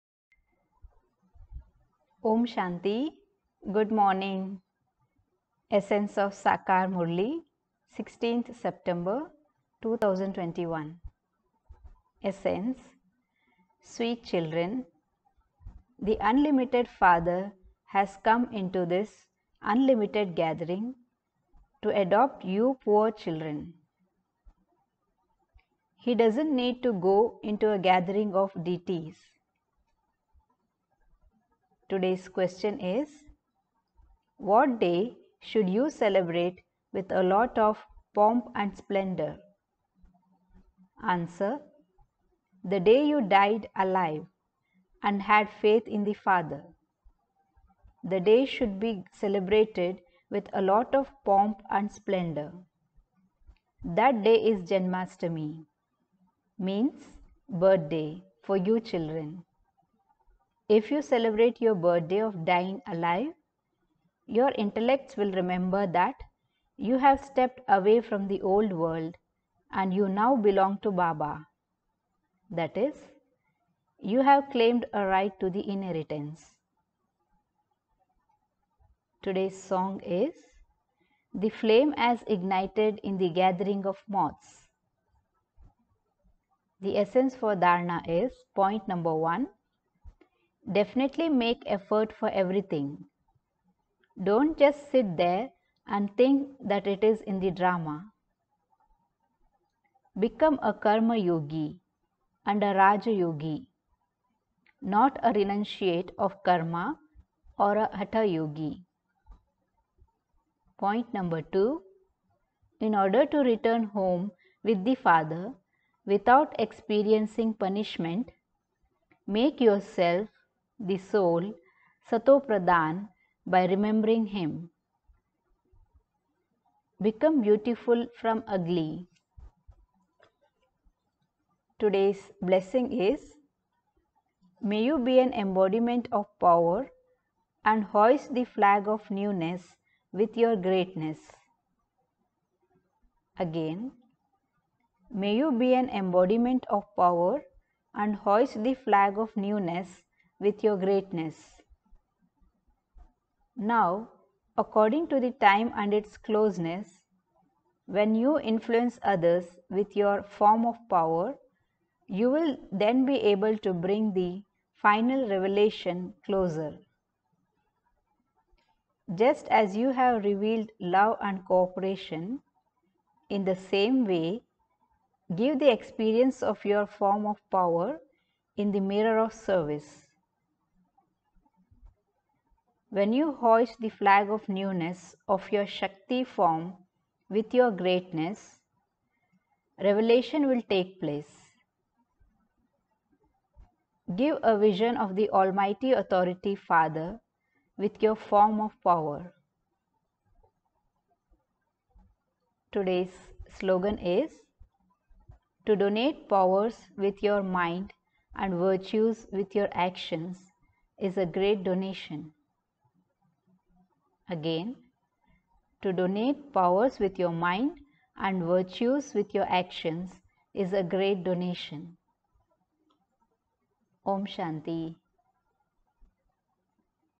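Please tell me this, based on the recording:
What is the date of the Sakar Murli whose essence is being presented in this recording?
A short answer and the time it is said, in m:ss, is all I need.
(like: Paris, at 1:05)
16th September 2021, at 0:07.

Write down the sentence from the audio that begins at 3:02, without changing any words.
When you hoist the flag of newness of your Shakti form with your greatness, revelation will take place.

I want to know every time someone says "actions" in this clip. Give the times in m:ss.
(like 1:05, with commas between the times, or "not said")
3:29, 3:39.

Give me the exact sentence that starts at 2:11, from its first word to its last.
Today's blessing is May you be an embodiment of power and hoist the flag of newness with your greatness.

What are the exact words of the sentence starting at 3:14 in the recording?
Give a vision of the Almighty Authority Father with your form of power.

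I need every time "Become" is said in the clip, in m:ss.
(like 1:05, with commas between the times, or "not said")
1:40, 2:07.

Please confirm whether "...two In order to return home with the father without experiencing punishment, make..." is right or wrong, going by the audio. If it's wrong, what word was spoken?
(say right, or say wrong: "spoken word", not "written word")
right.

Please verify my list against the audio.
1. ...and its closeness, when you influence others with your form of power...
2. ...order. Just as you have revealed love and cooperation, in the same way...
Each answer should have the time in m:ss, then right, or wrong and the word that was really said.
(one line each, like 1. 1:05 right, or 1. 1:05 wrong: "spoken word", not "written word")
1. 2:35 right
2. 2:46 wrong: "closer", not "order".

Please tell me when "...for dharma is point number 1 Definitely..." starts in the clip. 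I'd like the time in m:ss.
1:27.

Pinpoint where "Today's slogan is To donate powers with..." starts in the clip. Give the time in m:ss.
3:22.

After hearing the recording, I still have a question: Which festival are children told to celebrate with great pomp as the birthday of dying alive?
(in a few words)
Janmashtami.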